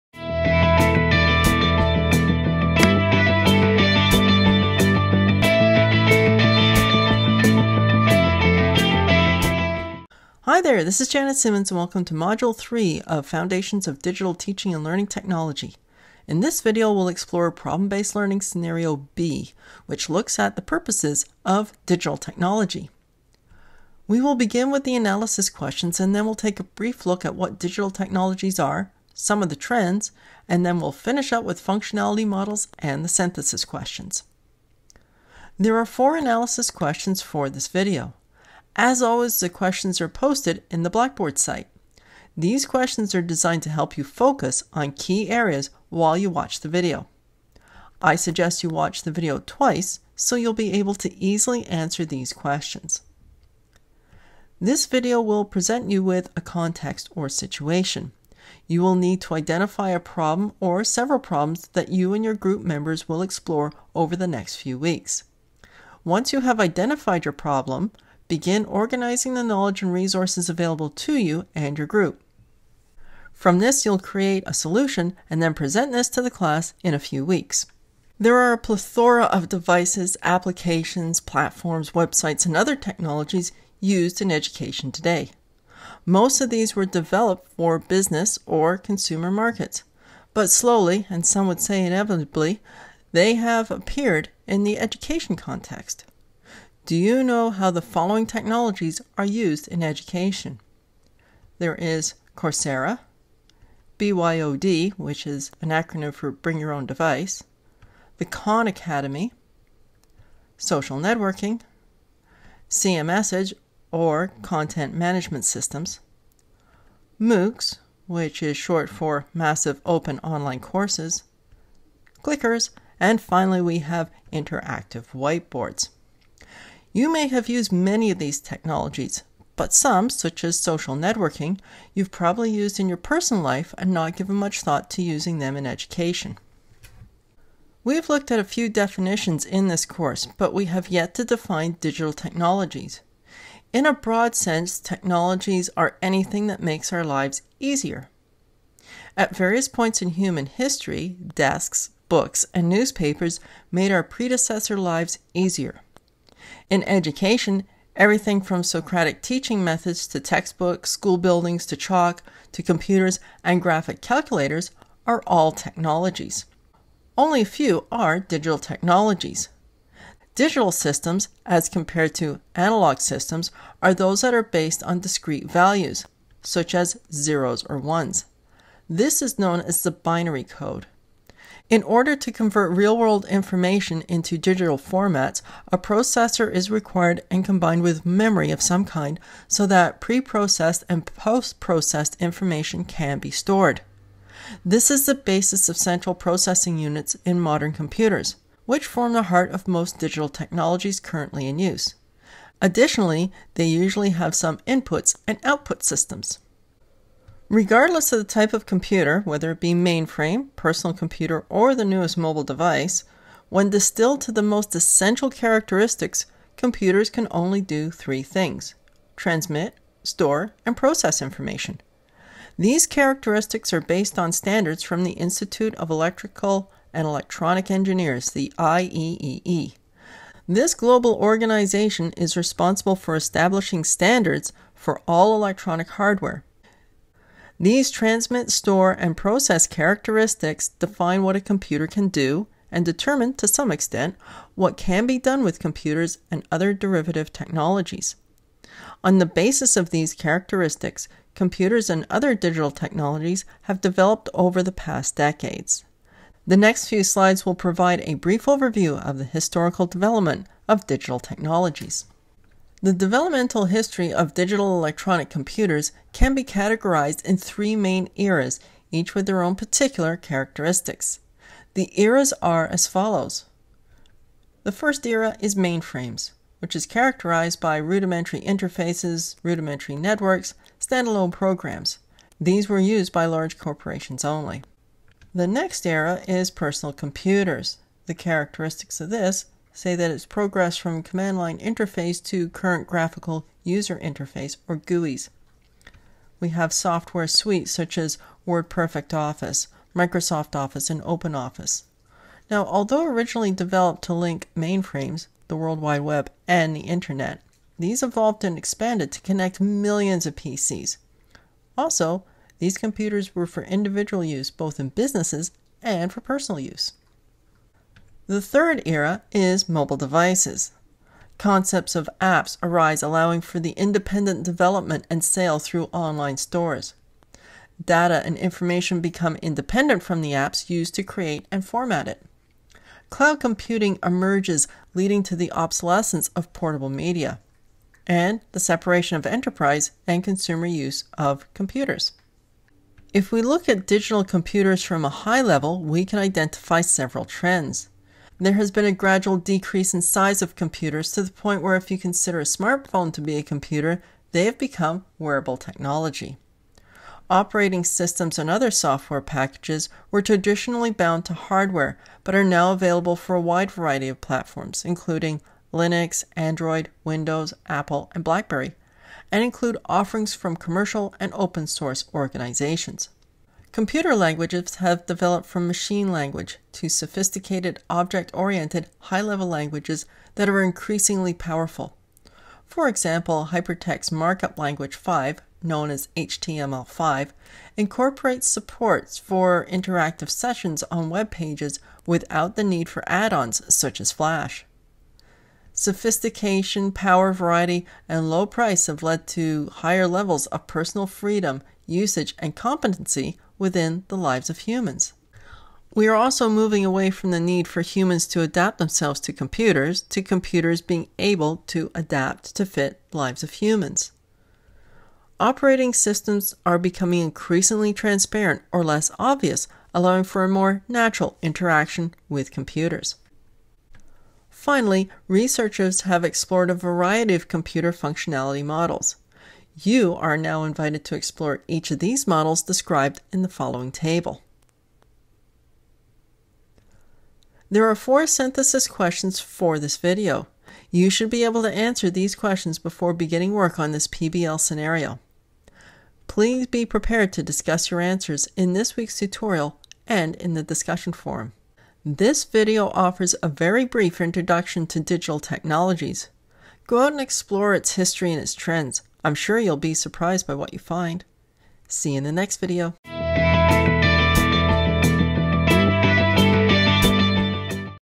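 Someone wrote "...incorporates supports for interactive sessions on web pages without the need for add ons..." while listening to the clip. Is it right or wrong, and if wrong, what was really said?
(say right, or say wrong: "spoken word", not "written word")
right.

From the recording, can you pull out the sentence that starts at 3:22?
Additionally, they usually have some inputs and output systems.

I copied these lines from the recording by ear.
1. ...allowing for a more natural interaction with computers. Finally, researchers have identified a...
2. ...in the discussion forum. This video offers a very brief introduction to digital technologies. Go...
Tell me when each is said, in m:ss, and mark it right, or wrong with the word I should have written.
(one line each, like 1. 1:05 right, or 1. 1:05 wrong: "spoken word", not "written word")
1. 6:59 wrong: "explored", not "identified"
2. 7:30 right.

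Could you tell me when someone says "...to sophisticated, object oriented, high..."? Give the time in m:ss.
6:16.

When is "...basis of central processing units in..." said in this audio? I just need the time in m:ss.
3:15.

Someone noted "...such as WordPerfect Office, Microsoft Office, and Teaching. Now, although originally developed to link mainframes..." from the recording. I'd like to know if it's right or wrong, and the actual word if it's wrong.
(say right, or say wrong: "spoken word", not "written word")
wrong: "OpenOffice", not "Teaching".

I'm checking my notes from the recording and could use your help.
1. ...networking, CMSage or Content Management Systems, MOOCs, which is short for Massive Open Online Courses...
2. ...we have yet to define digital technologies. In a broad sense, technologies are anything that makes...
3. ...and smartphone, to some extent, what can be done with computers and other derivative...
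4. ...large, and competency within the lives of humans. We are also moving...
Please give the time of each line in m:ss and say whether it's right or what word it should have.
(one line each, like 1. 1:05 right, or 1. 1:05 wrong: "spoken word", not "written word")
1. 1:50 right
2. 2:20 right
3. 4:02 wrong: "determine", not "smartphone"
4. 6:41 wrong: "usage", not "large".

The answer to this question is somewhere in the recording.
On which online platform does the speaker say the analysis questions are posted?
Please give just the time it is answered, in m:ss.
0:40.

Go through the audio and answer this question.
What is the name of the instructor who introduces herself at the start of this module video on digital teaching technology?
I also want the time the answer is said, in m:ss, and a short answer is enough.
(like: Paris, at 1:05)
Janet Simmons, at 0:11.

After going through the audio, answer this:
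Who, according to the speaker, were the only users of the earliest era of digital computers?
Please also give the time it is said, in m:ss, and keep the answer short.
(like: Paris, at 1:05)
Large corporations, at 4:43.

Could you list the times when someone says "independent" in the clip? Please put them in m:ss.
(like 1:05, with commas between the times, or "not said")
5:23, 5:29.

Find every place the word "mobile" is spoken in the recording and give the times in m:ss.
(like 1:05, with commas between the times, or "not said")
3:32, 5:19.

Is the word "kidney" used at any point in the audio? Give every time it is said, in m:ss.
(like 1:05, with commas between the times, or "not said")
not said.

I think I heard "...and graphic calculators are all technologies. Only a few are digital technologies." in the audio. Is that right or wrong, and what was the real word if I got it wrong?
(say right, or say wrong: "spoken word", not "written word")
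right.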